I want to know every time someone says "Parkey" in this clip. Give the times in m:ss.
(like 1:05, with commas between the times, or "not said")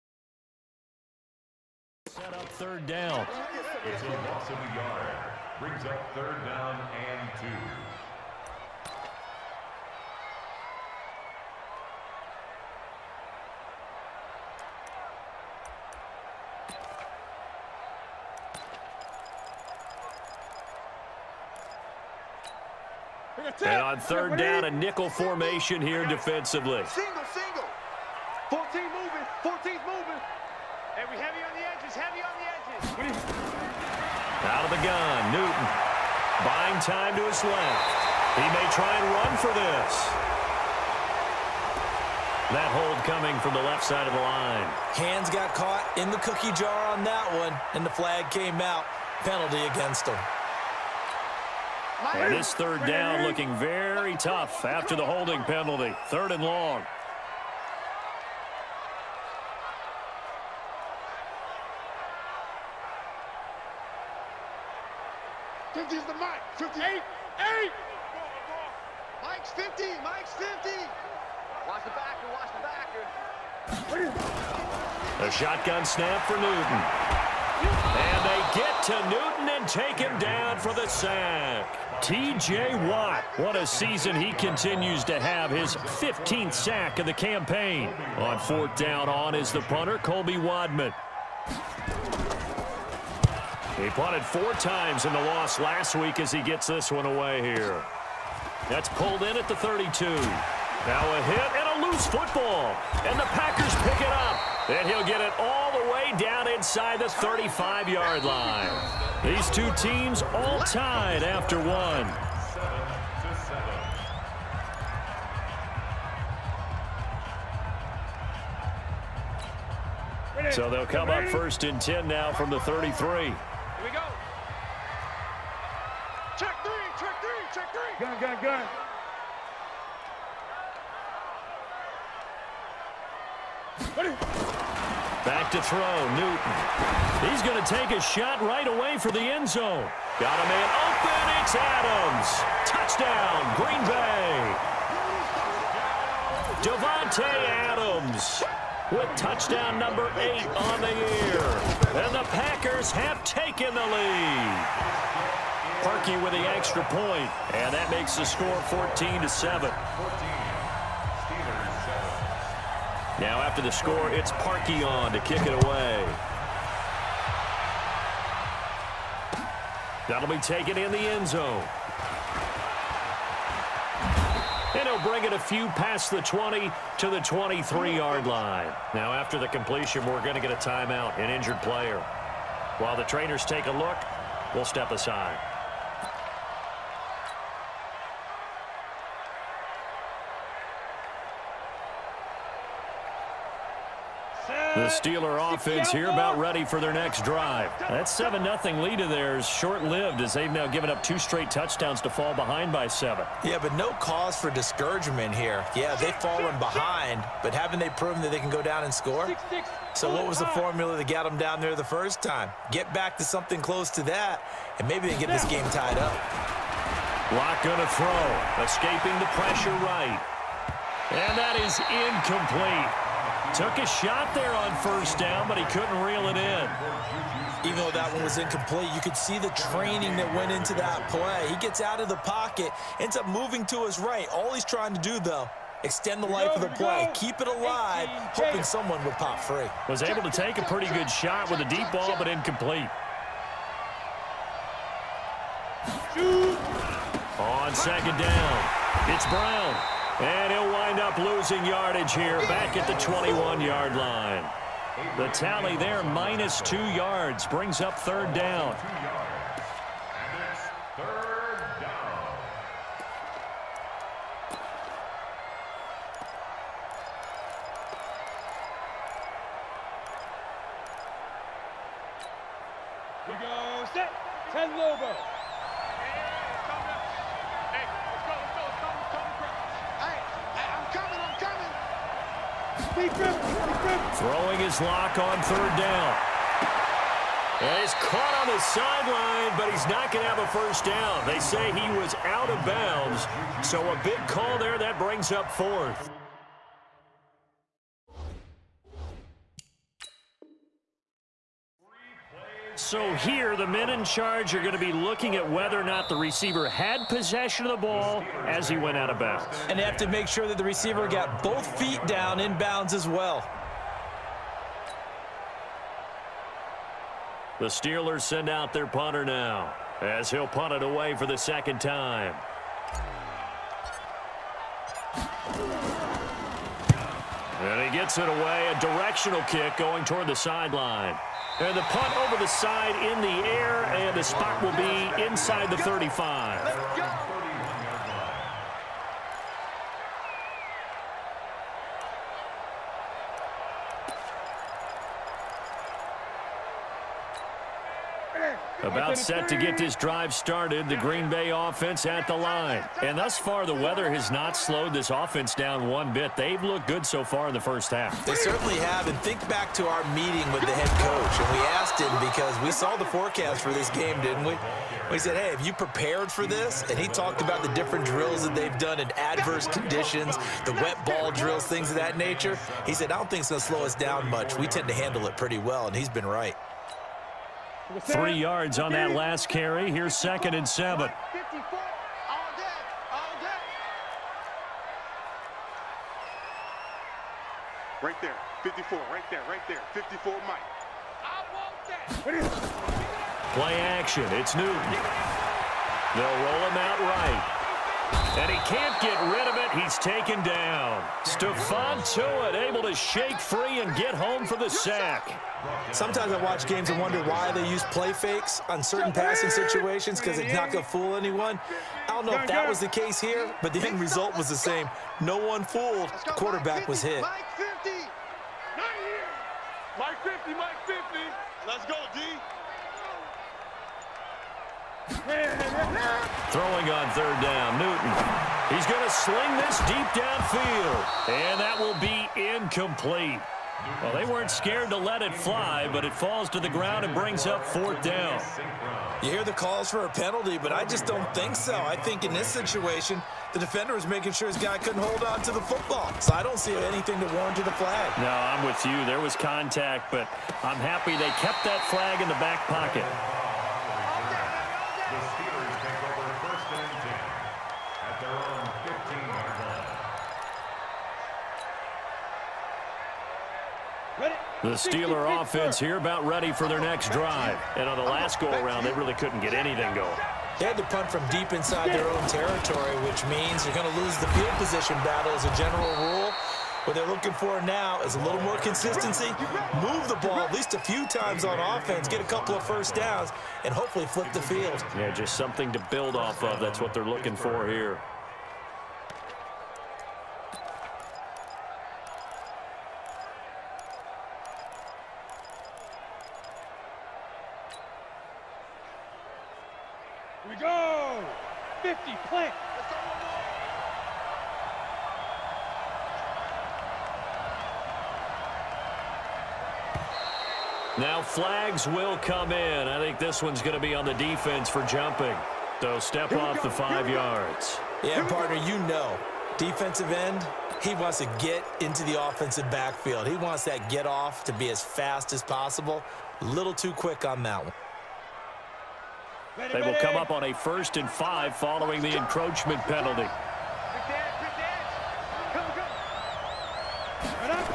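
2:35, 2:44.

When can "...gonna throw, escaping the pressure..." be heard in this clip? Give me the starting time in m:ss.
3:37.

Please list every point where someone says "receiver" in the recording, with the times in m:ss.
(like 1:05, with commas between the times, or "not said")
5:06, 5:10.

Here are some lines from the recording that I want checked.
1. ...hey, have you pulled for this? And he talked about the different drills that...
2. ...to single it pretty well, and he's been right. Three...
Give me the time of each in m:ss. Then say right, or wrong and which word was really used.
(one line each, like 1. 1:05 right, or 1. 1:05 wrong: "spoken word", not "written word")
1. 6:05 wrong: "prepared", not "pulled"
2. 6:14 wrong: "handle", not "single".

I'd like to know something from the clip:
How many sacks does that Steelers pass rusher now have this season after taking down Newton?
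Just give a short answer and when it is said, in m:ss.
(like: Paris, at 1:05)
15, at 1:25.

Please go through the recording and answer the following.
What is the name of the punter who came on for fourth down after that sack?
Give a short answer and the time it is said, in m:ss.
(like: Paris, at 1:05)
Colby Wadman, at 1:29.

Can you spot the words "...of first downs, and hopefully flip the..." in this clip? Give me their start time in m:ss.
8:02.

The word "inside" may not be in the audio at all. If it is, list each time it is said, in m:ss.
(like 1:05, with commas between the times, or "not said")
1:46, 5:35, 7:51.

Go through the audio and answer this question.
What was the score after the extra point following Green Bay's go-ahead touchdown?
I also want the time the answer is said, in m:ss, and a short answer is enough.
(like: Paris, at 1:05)
14 to 7, at 2:38.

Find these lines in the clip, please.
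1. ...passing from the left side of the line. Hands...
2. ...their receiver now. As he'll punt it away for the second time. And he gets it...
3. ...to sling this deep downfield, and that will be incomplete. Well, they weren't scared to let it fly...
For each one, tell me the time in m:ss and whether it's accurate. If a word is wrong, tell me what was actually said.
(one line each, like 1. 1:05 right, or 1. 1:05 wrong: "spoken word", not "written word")
1. 0:43 wrong: "coming", not "passing"
2. 5:18 wrong: "punter", not "receiver"
3. 7:09 right.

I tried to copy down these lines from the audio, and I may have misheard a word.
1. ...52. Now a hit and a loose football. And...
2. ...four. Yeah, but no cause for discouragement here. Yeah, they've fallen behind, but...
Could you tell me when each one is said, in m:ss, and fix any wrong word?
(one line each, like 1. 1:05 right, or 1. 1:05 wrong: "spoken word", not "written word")
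1. 1:39 wrong: "32", not "52"
2. 3:22 wrong: "seven", not "four".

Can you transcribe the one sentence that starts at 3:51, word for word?
He gets out of the pocket, ends up moving to his right.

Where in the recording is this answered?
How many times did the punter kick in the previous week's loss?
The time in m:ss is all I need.
1:34.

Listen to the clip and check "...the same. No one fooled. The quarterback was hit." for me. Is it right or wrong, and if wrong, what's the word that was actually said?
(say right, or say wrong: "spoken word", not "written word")
right.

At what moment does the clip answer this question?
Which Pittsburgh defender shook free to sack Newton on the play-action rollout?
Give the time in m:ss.
6:41.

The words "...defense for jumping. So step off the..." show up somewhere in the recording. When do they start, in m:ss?
8:34.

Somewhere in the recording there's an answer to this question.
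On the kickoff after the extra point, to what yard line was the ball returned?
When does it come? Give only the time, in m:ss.
2:57.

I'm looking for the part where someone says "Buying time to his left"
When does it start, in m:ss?
0:36.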